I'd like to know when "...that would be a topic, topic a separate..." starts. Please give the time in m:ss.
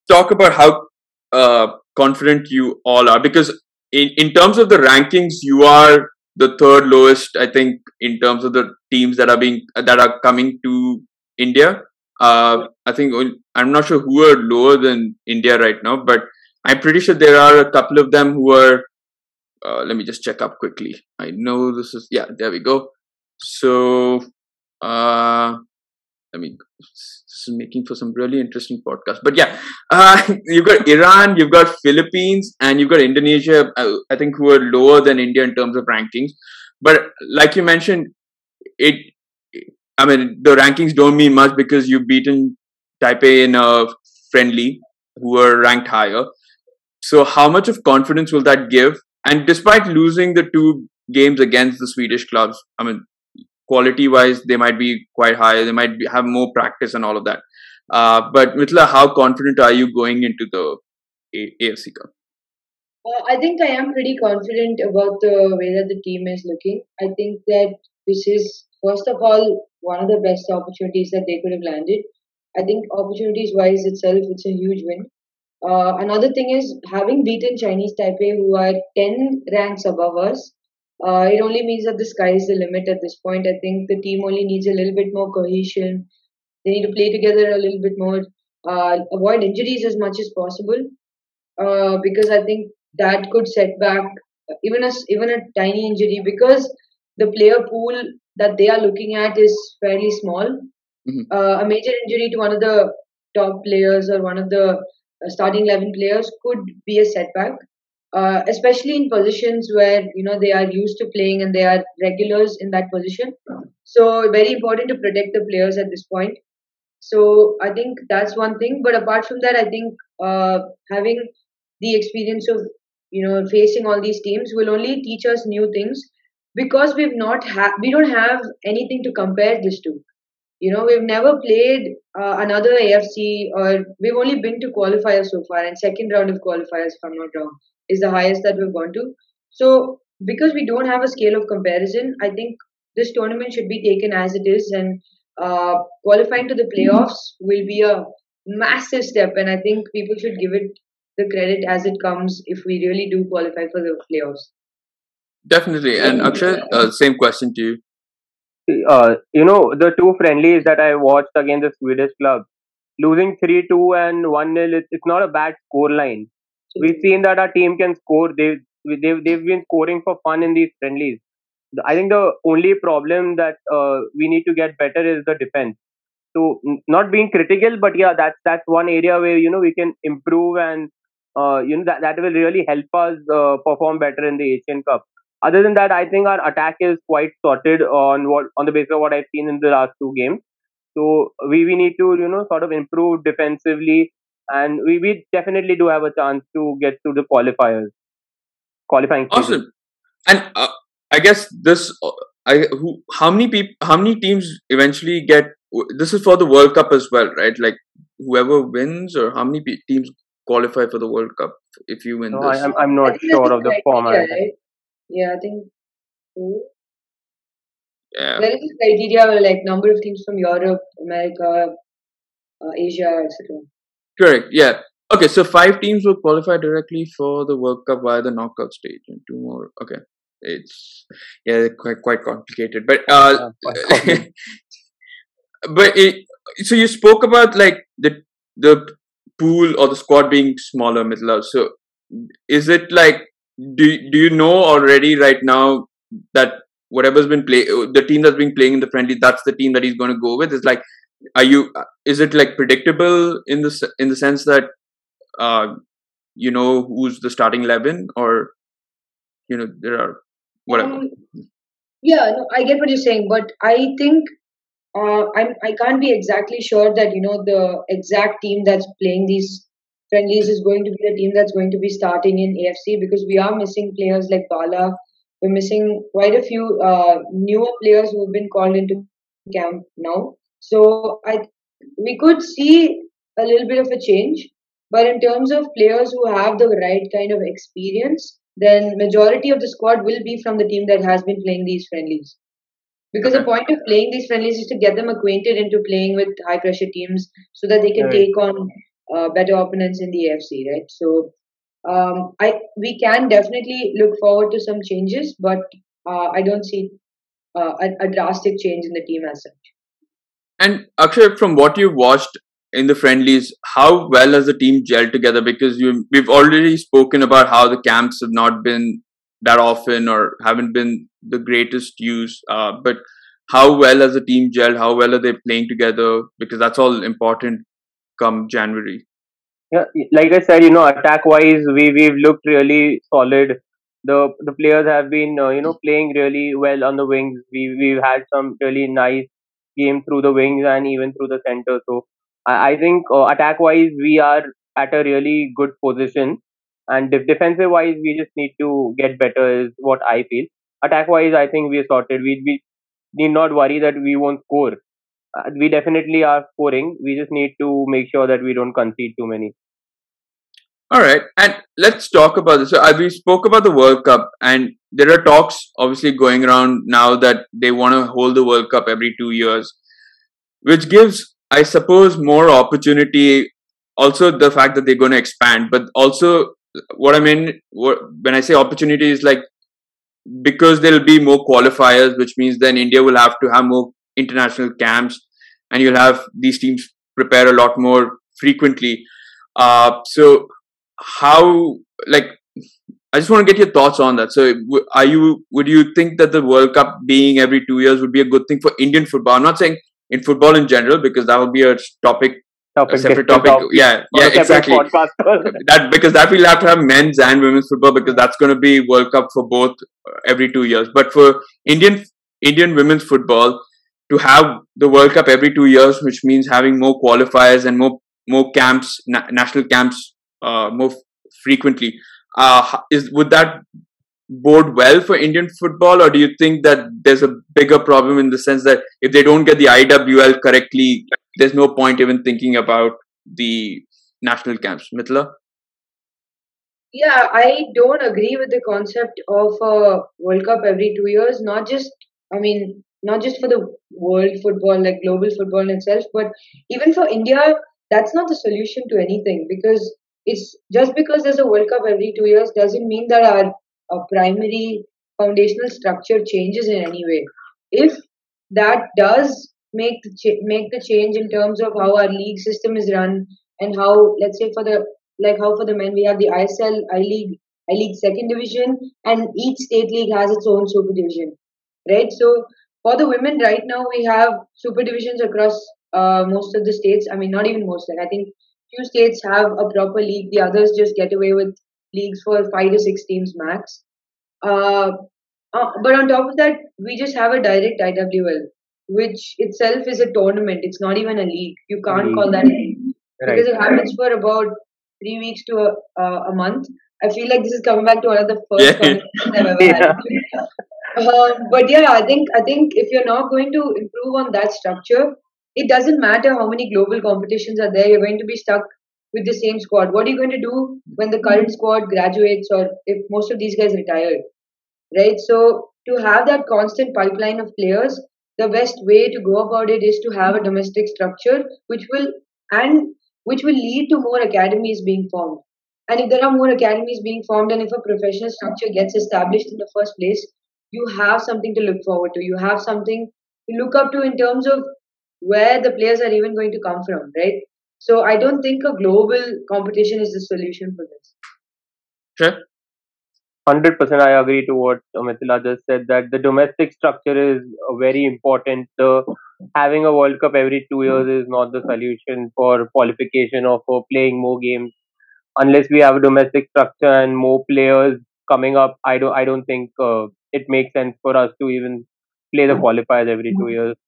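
6:41.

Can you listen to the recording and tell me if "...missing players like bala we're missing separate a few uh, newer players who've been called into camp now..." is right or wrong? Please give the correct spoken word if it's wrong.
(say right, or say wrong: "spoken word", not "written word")
wrong: "quite", not "separate".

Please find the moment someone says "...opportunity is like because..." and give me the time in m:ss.
6:18.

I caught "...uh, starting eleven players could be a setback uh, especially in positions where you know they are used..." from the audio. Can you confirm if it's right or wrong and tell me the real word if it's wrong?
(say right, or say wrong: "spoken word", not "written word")
right.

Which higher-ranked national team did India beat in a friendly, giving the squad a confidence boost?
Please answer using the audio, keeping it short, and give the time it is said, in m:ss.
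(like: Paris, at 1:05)
Chinese Taipei, at 1:17.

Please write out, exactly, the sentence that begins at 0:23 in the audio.
So, uh, I mean, this is making for some really interesting podcast.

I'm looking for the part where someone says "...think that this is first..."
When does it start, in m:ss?
1:07.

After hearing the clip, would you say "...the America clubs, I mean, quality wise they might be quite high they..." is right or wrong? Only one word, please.
wrong.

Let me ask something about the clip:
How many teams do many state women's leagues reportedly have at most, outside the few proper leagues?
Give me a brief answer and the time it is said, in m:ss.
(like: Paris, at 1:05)
5 to 6, at 8:02.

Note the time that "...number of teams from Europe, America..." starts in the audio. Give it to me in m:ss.
3:39.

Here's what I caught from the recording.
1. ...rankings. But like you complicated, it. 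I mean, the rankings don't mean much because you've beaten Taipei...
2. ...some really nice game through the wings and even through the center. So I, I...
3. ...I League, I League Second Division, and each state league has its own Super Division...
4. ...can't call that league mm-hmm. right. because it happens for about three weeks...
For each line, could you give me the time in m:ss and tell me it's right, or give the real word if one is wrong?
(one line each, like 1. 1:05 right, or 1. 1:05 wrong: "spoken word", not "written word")
1. 0:35 wrong: "mentioned", not "complicated"
2. 5:38 right
3. 7:46 right
4. 8:11 right.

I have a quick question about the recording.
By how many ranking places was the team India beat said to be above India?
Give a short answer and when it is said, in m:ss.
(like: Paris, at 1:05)
10, at 1:18.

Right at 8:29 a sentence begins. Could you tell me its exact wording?
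What are you going to do when the current hmm.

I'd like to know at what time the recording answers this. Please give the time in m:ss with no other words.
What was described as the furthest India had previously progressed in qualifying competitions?
2:15.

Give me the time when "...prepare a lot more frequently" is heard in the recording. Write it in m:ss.
6:27.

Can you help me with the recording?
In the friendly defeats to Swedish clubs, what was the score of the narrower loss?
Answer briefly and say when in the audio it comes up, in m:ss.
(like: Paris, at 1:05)
1-0, at 2:44.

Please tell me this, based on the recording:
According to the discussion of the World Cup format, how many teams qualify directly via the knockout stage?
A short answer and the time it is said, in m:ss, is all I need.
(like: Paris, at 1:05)
5, at 3:45.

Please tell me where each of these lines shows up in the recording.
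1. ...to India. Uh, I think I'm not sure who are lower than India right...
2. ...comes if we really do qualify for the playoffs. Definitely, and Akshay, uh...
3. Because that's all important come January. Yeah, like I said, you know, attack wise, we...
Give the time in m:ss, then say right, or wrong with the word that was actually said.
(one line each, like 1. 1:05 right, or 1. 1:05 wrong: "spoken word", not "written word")
1. 0:10 right
2. 2:32 right
3. 5:26 right.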